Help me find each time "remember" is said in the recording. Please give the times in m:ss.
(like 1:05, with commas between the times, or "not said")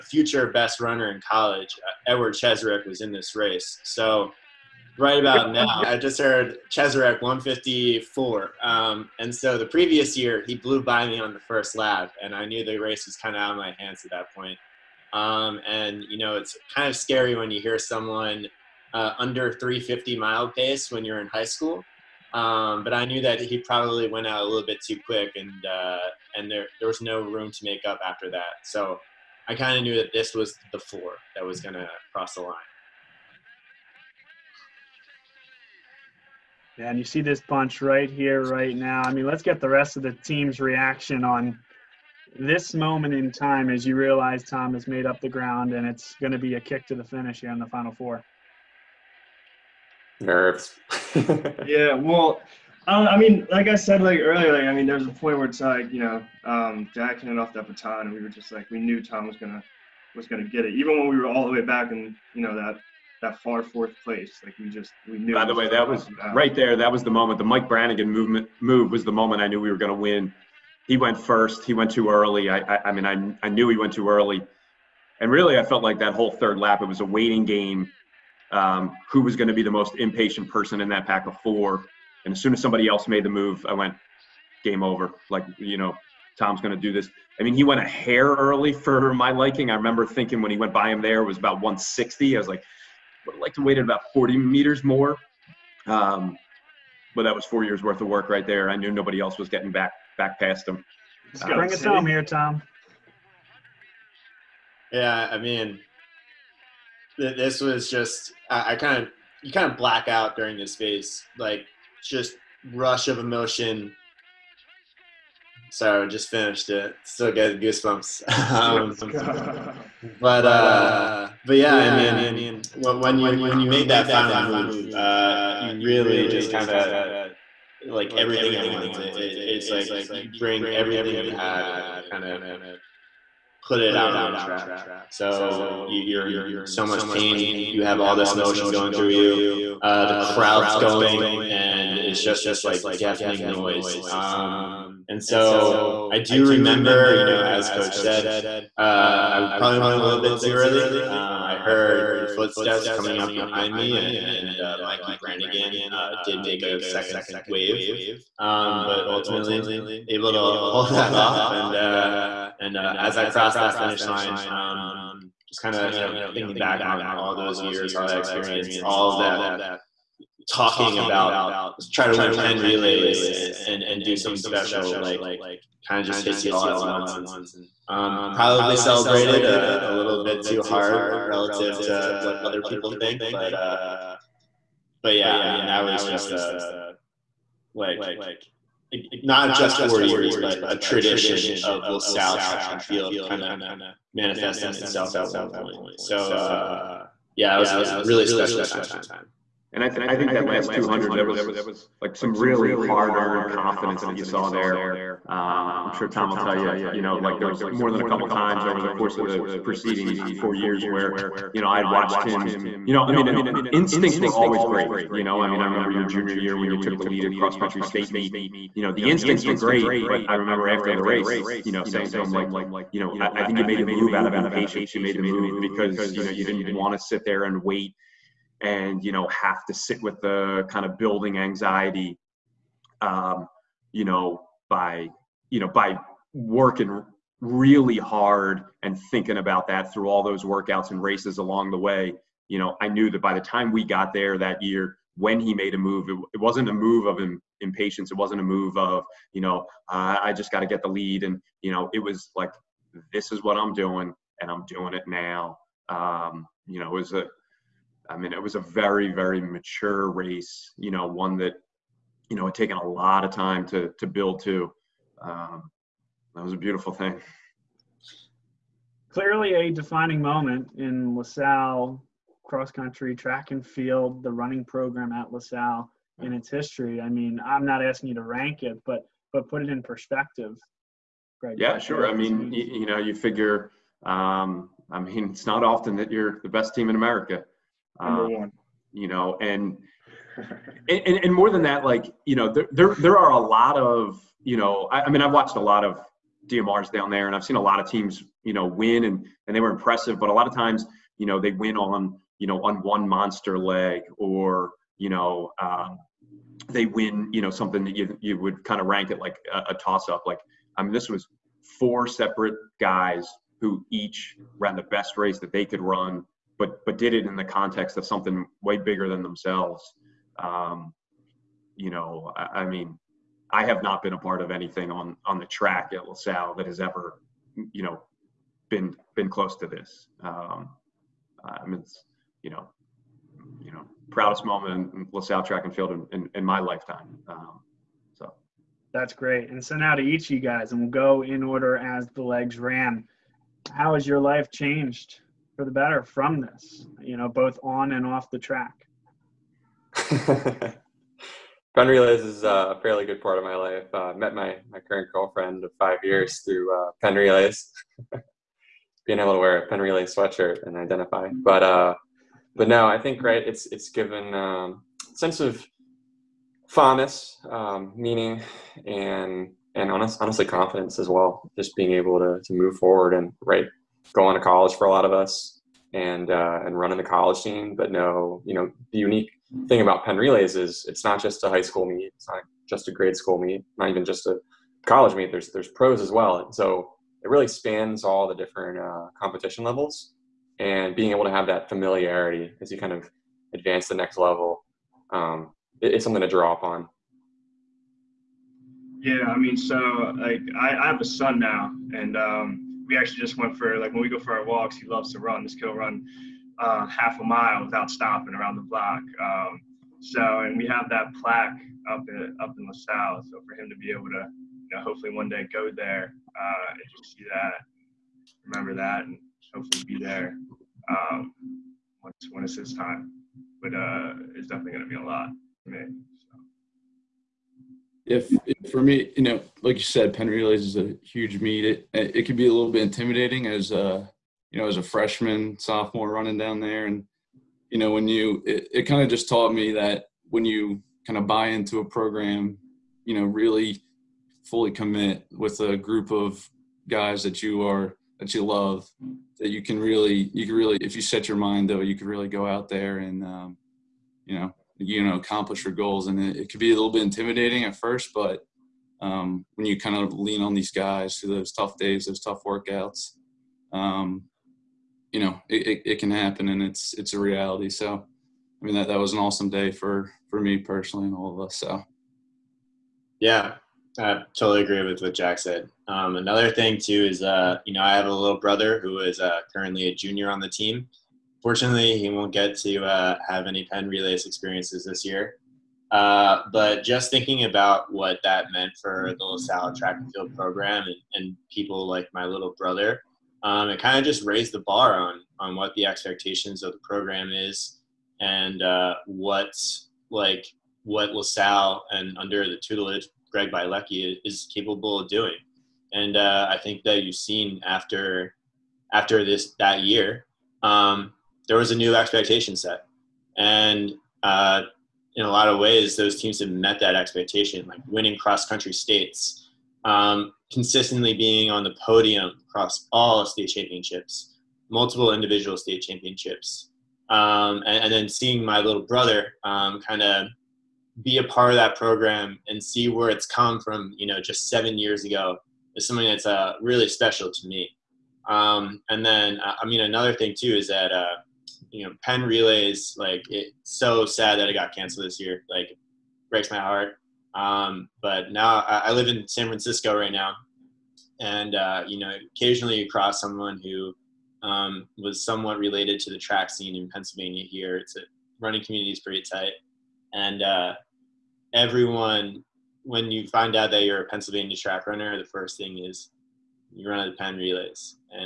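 1:29, 2:26, 3:35, 3:40, 6:58.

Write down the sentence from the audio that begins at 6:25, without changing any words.
There's there's pros as well, and so it really spans all the different uh, competition levels.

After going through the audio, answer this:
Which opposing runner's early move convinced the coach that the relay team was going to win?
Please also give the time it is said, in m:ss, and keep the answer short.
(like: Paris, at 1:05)
Mike Brannigan, at 1:07.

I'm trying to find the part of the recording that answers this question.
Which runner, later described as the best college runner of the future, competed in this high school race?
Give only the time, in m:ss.
0:02.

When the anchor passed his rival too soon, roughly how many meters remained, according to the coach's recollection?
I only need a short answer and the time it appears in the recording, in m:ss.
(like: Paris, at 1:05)
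160, at 1:31.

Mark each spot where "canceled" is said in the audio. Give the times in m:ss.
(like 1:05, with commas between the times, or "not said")
9:04.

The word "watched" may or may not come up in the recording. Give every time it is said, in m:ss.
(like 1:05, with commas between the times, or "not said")
3:31, 4:55.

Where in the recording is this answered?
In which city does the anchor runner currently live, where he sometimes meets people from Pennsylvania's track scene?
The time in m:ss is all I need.
9:09.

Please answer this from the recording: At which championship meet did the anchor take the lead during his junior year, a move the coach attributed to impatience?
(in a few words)
cross country state meet.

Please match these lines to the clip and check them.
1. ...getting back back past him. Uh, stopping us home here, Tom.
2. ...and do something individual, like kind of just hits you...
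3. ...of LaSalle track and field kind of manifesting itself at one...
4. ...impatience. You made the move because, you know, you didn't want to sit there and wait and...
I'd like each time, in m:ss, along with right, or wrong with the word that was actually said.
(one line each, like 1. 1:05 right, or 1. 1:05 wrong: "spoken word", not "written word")
1. 1:39 wrong: "bring", not "stopping"
2. 2:53 wrong: "special", not "individual"
3. 3:11 right
4. 3:44 right.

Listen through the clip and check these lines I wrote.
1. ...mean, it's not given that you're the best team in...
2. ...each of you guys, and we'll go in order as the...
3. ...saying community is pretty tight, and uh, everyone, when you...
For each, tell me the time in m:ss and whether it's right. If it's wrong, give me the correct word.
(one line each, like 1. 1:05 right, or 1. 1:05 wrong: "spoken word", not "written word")
1. 4:44 wrong: "often", not "given"
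2. 5:40 right
3. 9:18 wrong: "running", not "saying".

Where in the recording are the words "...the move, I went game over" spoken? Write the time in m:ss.
1:23.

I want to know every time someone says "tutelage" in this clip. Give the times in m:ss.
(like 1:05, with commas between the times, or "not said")
8:22.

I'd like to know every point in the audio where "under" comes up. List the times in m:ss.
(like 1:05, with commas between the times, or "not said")
0:19, 8:22.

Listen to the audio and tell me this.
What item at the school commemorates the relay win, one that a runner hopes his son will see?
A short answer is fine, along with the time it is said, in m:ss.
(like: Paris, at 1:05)
plaque, at 6:51.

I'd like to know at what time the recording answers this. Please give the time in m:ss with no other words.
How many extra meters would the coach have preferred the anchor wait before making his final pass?
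1:34.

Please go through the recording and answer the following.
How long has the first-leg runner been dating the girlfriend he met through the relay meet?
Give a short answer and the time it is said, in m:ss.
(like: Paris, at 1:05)
5 years, at 5:55.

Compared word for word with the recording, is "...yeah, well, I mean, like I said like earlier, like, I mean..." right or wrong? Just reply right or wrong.
right.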